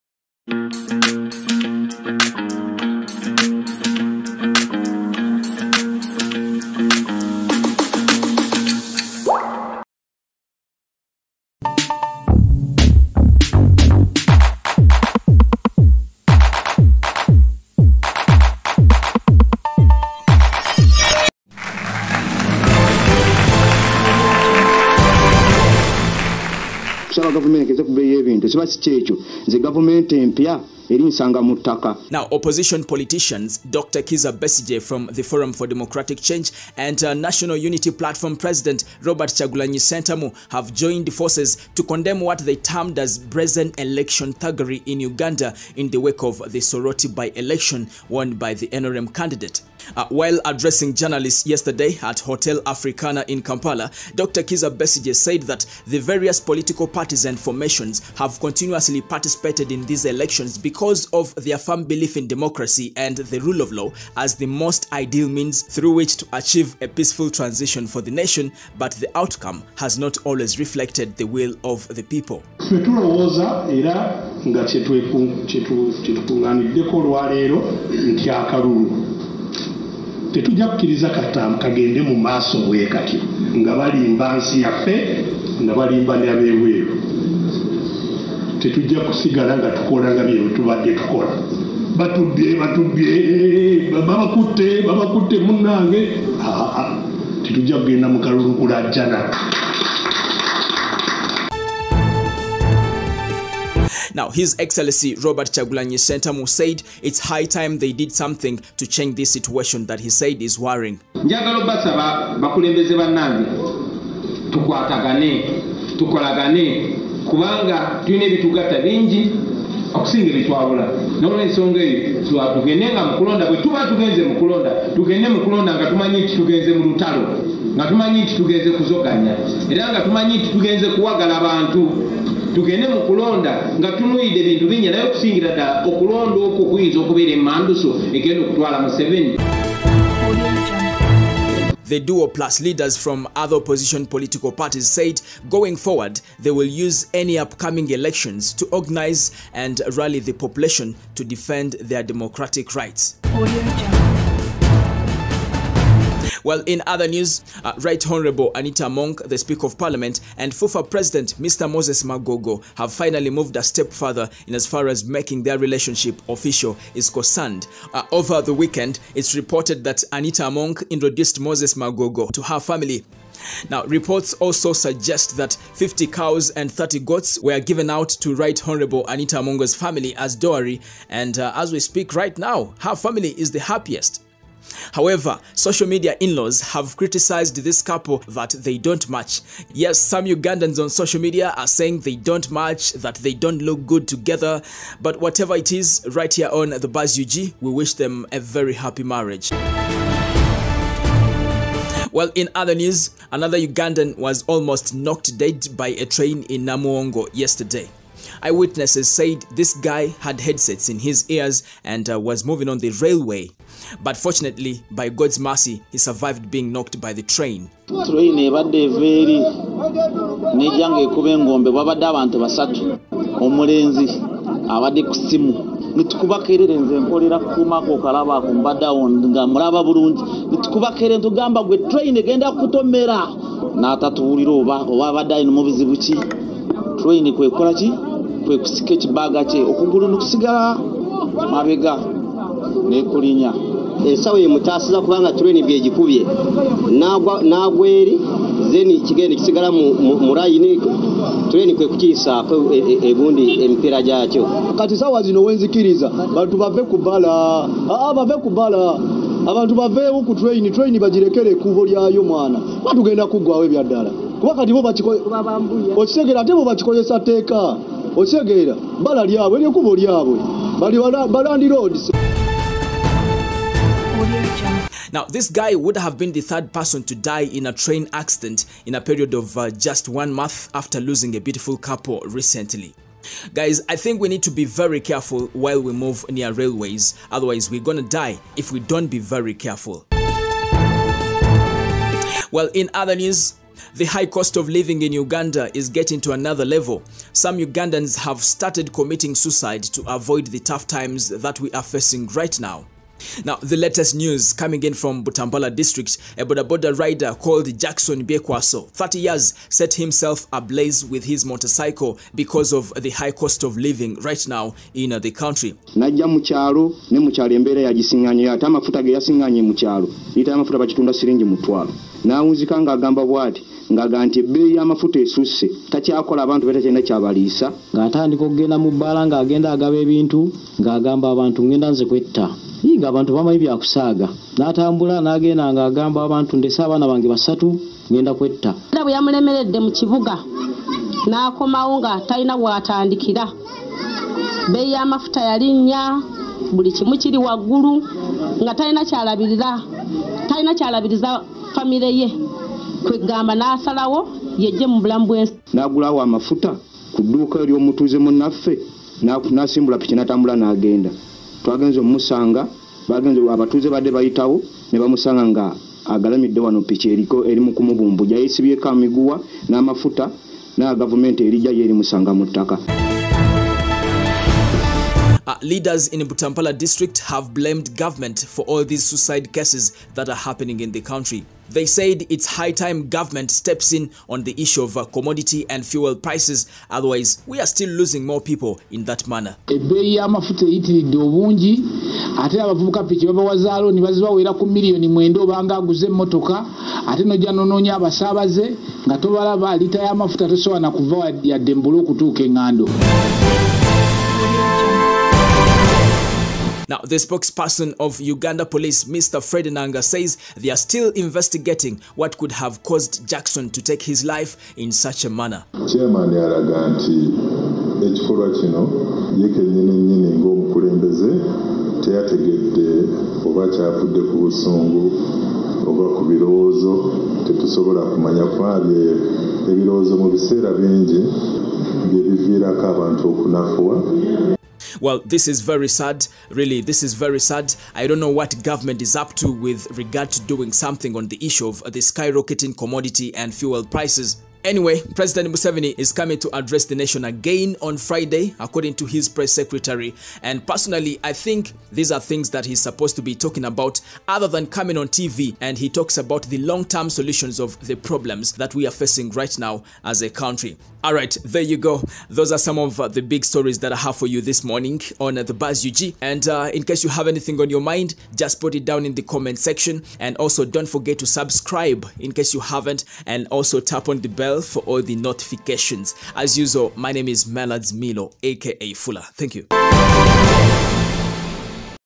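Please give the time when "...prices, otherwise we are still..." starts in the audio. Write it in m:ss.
6:26.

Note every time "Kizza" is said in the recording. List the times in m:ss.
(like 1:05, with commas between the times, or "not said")
0:34, 0:54.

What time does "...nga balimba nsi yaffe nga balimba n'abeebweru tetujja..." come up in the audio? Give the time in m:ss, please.
1:23.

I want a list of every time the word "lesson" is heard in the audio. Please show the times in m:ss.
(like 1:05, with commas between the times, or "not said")
not said.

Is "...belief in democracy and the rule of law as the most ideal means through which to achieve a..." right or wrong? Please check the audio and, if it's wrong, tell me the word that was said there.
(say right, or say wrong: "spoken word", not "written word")
right.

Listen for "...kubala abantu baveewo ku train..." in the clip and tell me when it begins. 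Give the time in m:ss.
4:18.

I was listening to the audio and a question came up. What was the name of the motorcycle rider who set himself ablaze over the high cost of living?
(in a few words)
Jackson Biekwaso.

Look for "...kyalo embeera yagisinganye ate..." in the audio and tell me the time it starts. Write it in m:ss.
5:17.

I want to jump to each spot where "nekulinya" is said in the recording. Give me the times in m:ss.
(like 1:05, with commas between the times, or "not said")
4:02.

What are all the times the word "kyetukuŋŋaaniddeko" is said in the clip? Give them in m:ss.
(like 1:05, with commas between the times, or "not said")
1:14.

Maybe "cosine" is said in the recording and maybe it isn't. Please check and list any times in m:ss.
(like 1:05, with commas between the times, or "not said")
not said.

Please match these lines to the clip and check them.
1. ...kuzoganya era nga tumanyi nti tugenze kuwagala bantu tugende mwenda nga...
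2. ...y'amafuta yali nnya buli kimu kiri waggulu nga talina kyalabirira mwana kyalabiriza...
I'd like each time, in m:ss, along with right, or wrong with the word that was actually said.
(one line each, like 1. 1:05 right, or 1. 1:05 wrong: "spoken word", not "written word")
1. 2:08 wrong: "mukulonda", not "mwenda"
2. 5:44 wrong: "talina", not "mwana".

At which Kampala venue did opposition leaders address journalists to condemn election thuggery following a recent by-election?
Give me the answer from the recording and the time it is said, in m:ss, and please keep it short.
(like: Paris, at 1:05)
Hotel Africana, at 0:52.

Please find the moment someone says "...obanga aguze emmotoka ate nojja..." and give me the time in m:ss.
6:35.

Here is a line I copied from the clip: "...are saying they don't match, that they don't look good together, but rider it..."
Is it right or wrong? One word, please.
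wrong.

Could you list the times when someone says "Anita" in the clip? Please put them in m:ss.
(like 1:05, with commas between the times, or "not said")
2:38, 2:50, 2:59.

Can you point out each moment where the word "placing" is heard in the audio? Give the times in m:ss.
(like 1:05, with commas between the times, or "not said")
not said.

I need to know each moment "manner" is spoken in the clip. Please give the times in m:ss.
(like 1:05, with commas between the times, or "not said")
6:29, 6:55.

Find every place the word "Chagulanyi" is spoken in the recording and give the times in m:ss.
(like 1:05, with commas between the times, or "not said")
1:45.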